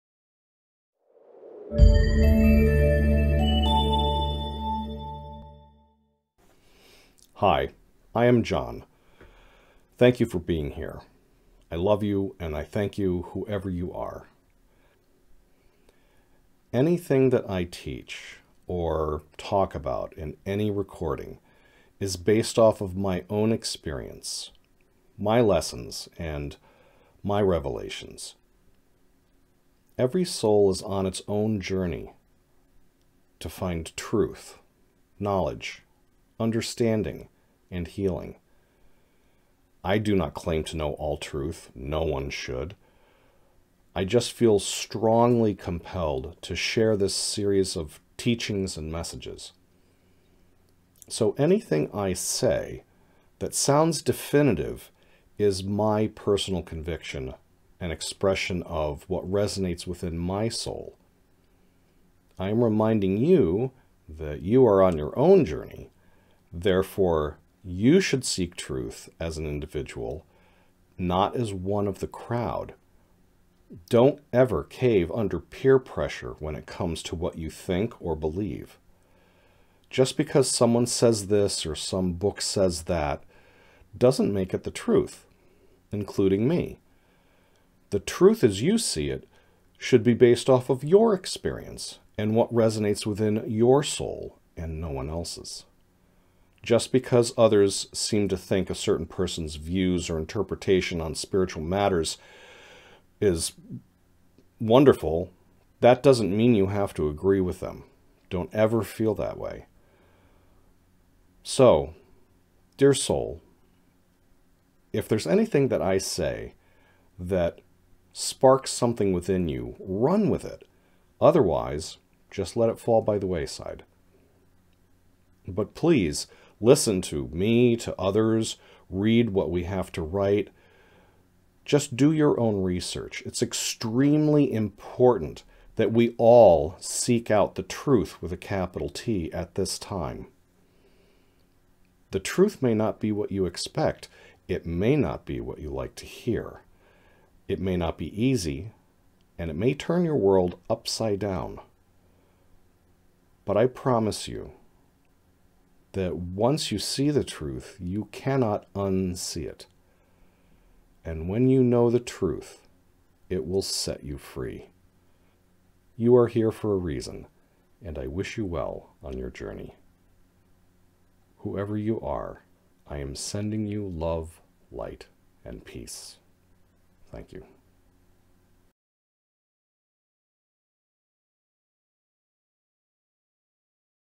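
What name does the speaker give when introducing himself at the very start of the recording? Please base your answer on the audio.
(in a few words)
John.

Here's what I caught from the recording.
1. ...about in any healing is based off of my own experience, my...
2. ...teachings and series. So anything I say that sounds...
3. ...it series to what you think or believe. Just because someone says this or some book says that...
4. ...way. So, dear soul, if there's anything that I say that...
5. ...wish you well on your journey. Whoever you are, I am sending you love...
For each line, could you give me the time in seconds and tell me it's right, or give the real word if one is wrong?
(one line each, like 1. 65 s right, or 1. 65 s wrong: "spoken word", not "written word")
1. 19 s wrong: "recording", not "healing"
2. 48 s wrong: "messages", not "series"
3. 76 s wrong: "comes", not "series"
4. 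109 s right
5. 168 s right.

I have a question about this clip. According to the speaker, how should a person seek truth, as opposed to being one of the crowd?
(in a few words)
As an individual.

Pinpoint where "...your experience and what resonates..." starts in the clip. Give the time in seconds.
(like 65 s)
90 s.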